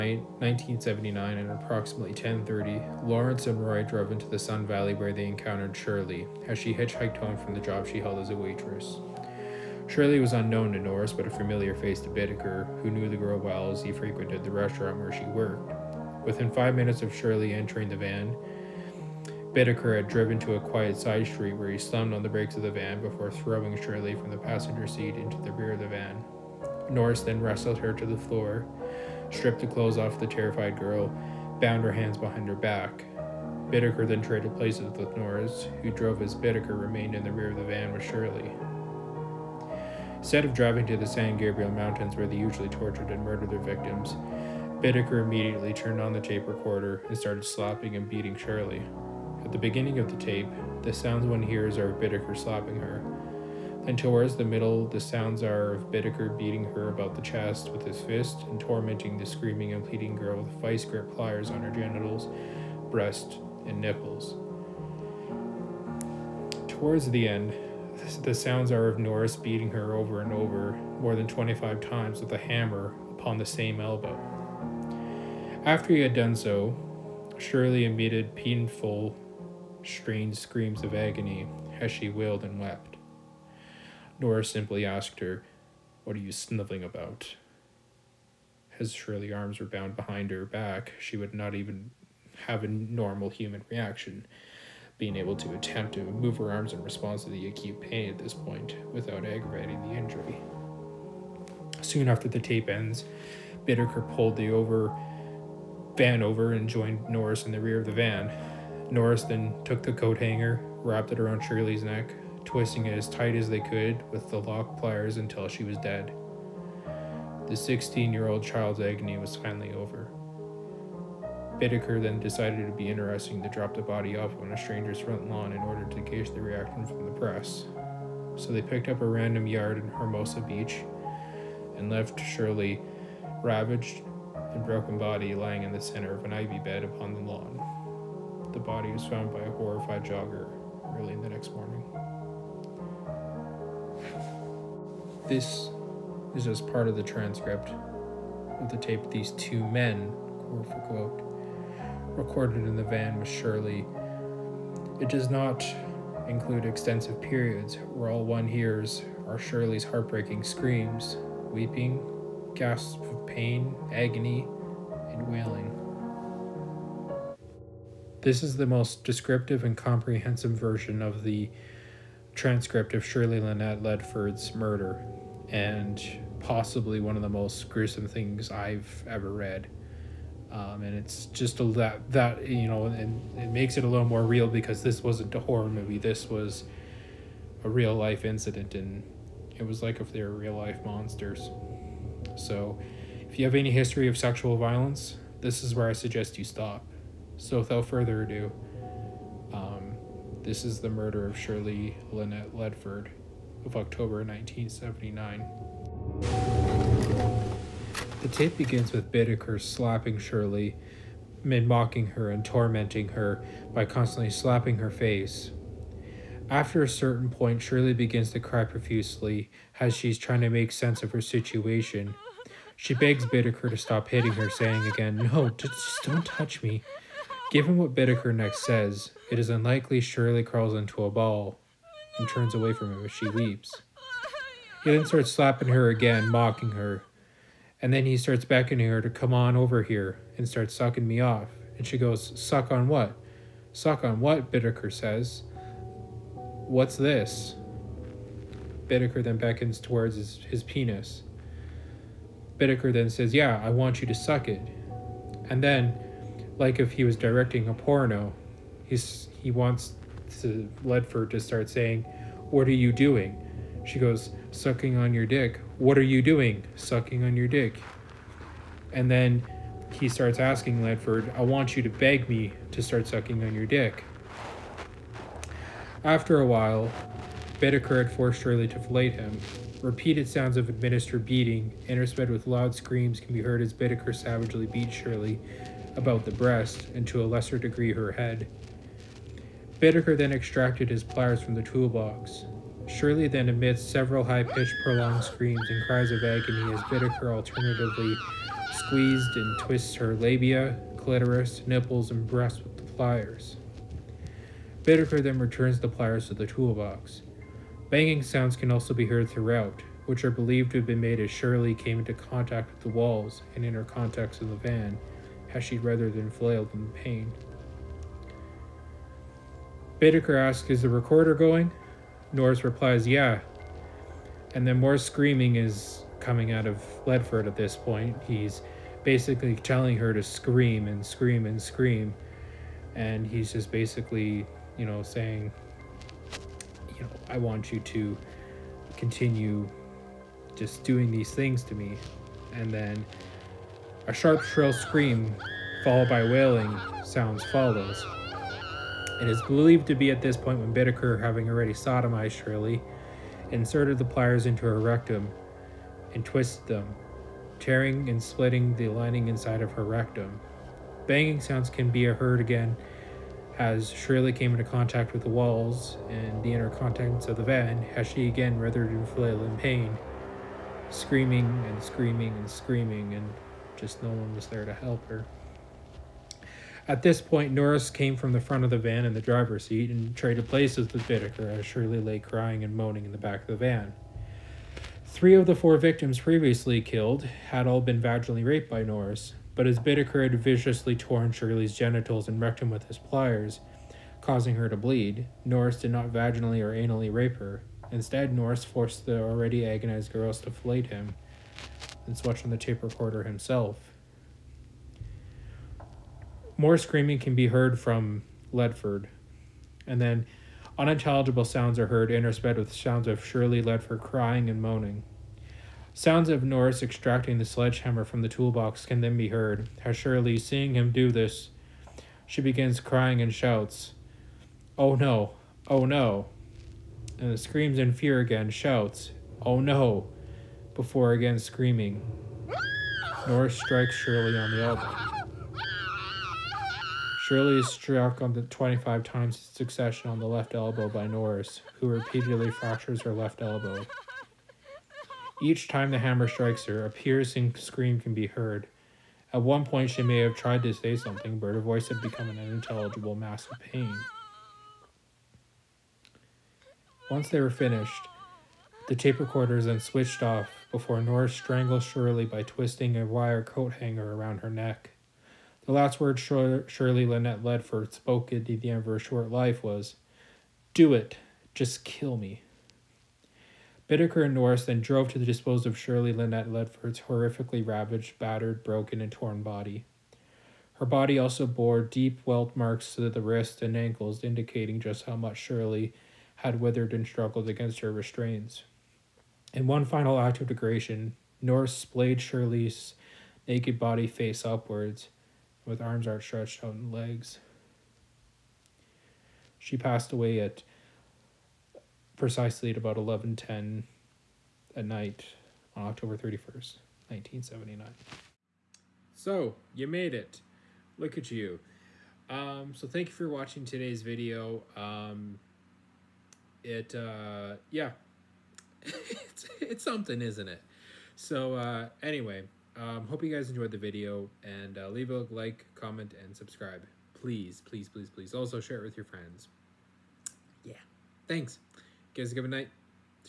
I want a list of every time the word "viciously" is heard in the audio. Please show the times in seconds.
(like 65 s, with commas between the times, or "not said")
390 s.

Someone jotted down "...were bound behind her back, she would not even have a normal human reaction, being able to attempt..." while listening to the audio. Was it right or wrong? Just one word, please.
right.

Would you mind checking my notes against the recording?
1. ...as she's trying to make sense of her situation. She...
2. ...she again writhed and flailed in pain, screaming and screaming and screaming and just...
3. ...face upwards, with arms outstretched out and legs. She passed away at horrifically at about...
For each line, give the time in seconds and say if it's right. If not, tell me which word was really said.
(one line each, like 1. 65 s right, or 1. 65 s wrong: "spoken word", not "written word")
1. 219 s right
2. 368 s right
3. 494 s wrong: "precisely", not "horrifically".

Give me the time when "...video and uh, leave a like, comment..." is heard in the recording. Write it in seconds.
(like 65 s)
523 s.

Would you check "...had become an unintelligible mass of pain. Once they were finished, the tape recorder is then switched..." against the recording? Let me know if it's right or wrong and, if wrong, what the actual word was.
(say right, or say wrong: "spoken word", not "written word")
right.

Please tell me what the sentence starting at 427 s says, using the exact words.
And screams in fear again, shouts, Oh no, before again screaming.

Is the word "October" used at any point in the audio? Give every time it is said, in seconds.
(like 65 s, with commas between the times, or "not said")
203 s, 505 s.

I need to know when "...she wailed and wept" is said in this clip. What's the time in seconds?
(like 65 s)
81 s.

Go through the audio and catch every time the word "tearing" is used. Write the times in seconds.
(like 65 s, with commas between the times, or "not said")
357 s.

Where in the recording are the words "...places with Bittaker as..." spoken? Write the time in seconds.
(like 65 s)
380 s.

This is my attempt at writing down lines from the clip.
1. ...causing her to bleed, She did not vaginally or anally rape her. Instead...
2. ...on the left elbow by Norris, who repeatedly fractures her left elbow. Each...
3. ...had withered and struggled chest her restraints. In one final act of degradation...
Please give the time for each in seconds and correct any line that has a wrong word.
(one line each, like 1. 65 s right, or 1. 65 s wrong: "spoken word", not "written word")
1. 394 s wrong: "Norris", not "She"
2. 440 s right
3. 486 s wrong: "against", not "chest".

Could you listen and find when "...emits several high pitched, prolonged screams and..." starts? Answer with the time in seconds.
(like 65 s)
293 s.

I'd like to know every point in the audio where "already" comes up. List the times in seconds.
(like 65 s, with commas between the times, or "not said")
351 s, 399 s.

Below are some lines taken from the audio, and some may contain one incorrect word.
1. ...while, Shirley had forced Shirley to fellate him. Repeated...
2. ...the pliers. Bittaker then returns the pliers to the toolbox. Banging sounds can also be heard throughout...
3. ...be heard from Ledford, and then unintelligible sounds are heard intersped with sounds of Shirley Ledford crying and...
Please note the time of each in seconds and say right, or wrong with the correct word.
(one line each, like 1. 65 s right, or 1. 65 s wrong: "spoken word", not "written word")
1. 276 s wrong: "Bittaker", not "Shirley"
2. 302 s right
3. 407 s right.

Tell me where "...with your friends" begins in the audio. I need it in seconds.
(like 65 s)
528 s.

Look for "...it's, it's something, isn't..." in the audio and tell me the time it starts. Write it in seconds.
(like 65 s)
519 s.